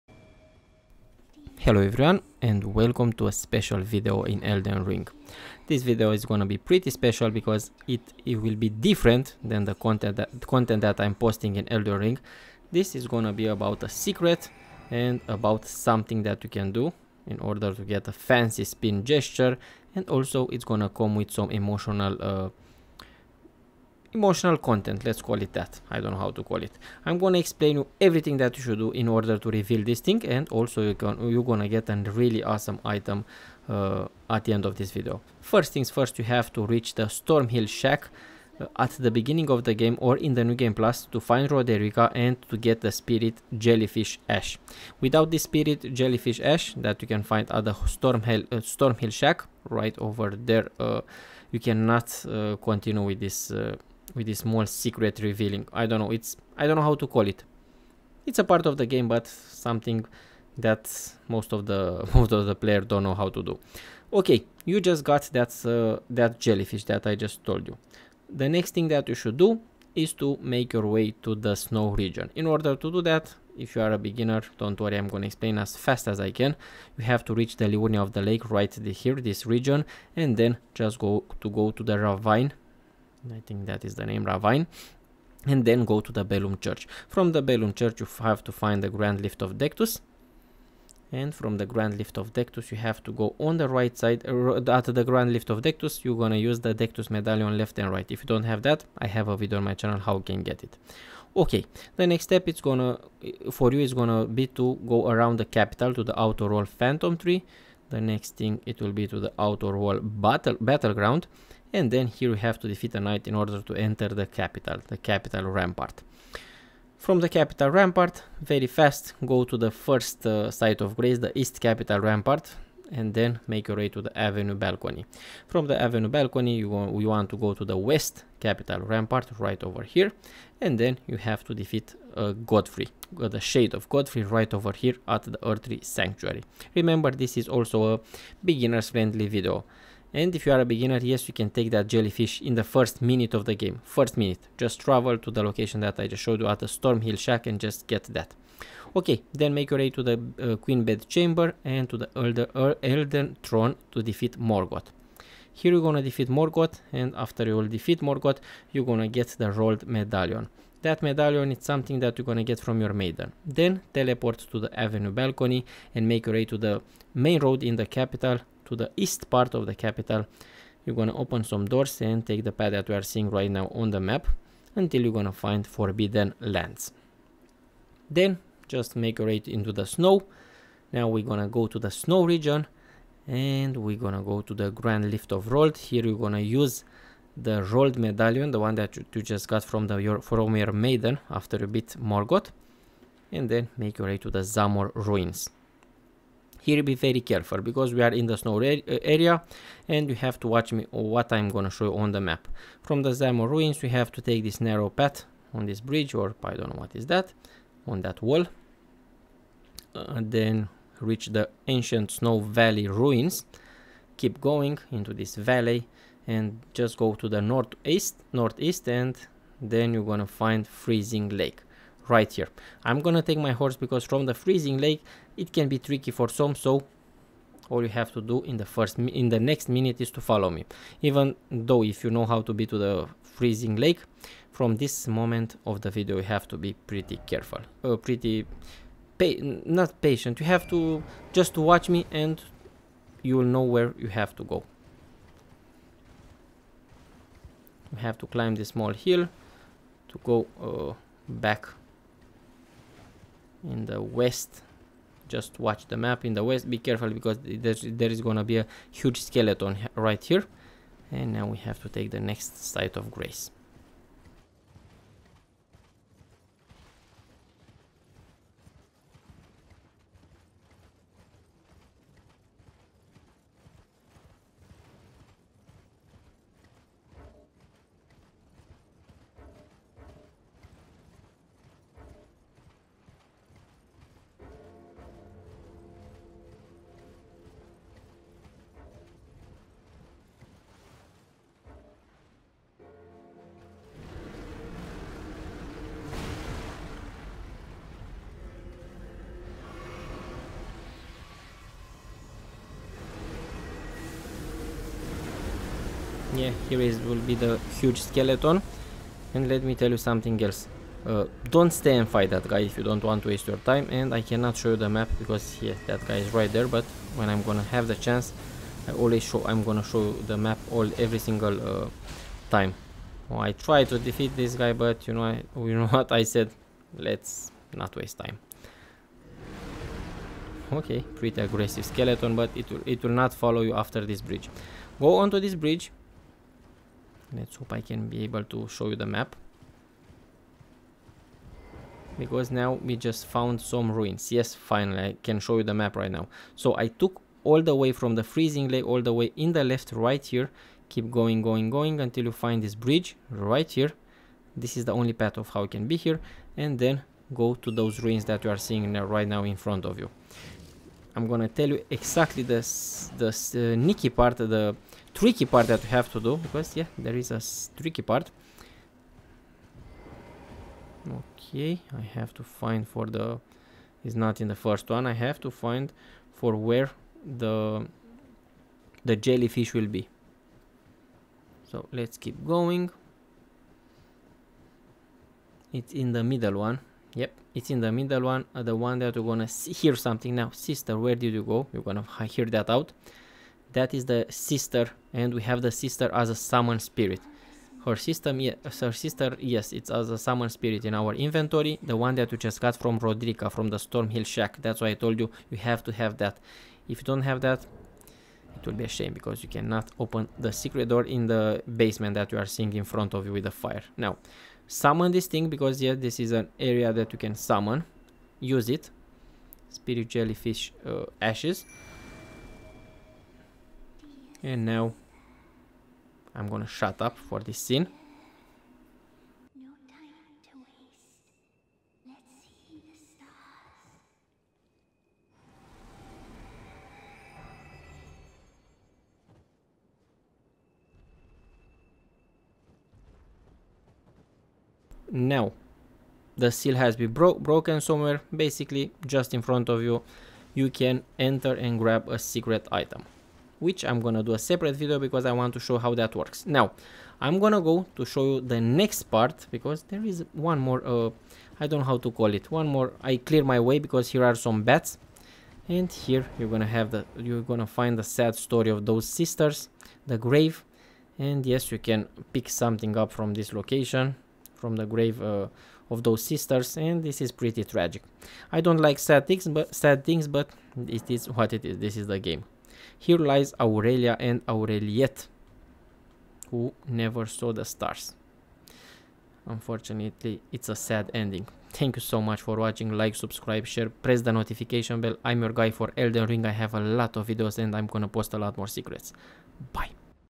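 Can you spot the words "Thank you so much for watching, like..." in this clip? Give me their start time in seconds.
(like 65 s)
491 s.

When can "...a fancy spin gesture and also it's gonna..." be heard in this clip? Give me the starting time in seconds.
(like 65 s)
18 s.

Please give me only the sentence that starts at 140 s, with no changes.
And if you are a beginner, yes, you can take that jellyfish in the first minute of the game.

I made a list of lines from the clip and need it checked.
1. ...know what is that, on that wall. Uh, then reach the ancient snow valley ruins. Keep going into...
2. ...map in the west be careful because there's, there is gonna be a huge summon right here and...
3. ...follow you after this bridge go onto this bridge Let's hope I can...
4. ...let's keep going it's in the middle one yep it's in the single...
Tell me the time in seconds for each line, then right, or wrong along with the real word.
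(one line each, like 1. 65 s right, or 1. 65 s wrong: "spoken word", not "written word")
1. 206 s right
2. 255 s wrong: "skeleton", not "summon"
3. 333 s right
4. 381 s wrong: "middle", not "single".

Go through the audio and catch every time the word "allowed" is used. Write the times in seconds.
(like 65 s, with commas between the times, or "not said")
not said.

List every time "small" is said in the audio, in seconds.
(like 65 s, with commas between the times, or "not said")
54 s, 248 s.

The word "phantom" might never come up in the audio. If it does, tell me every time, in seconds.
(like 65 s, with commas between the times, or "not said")
106 s.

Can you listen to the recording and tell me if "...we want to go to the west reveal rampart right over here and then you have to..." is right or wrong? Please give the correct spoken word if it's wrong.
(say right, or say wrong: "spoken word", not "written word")
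wrong: "capital", not "reveal".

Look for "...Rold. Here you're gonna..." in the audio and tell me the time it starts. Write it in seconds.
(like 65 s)
185 s.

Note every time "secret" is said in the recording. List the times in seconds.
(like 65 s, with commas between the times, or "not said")
13 s, 54 s, 410 s, 452 s, 498 s.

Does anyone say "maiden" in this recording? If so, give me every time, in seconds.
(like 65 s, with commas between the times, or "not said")
162 s, 190 s.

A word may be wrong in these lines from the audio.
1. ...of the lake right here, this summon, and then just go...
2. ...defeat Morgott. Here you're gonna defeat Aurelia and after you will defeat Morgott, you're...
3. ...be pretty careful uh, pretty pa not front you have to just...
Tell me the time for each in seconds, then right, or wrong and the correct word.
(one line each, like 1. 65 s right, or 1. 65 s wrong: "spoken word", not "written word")
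1. 78 s wrong: "region", not "summon"
2. 154 s wrong: "Morgott", not "Aurelia"
3. 236 s wrong: "patient", not "front".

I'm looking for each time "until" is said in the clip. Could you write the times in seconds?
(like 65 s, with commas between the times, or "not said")
174 s, 352 s.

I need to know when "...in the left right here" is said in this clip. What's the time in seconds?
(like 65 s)
349 s.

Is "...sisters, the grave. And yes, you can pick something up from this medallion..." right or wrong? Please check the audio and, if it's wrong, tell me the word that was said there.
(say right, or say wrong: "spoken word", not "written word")
wrong: "location", not "medallion".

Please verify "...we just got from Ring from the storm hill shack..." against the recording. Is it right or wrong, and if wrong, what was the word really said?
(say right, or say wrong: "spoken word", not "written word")
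wrong: "Roderika", not "Ring".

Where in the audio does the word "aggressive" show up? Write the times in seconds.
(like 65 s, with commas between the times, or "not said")
331 s.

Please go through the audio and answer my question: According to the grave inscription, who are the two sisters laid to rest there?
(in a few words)
Aurelia and Aureliette.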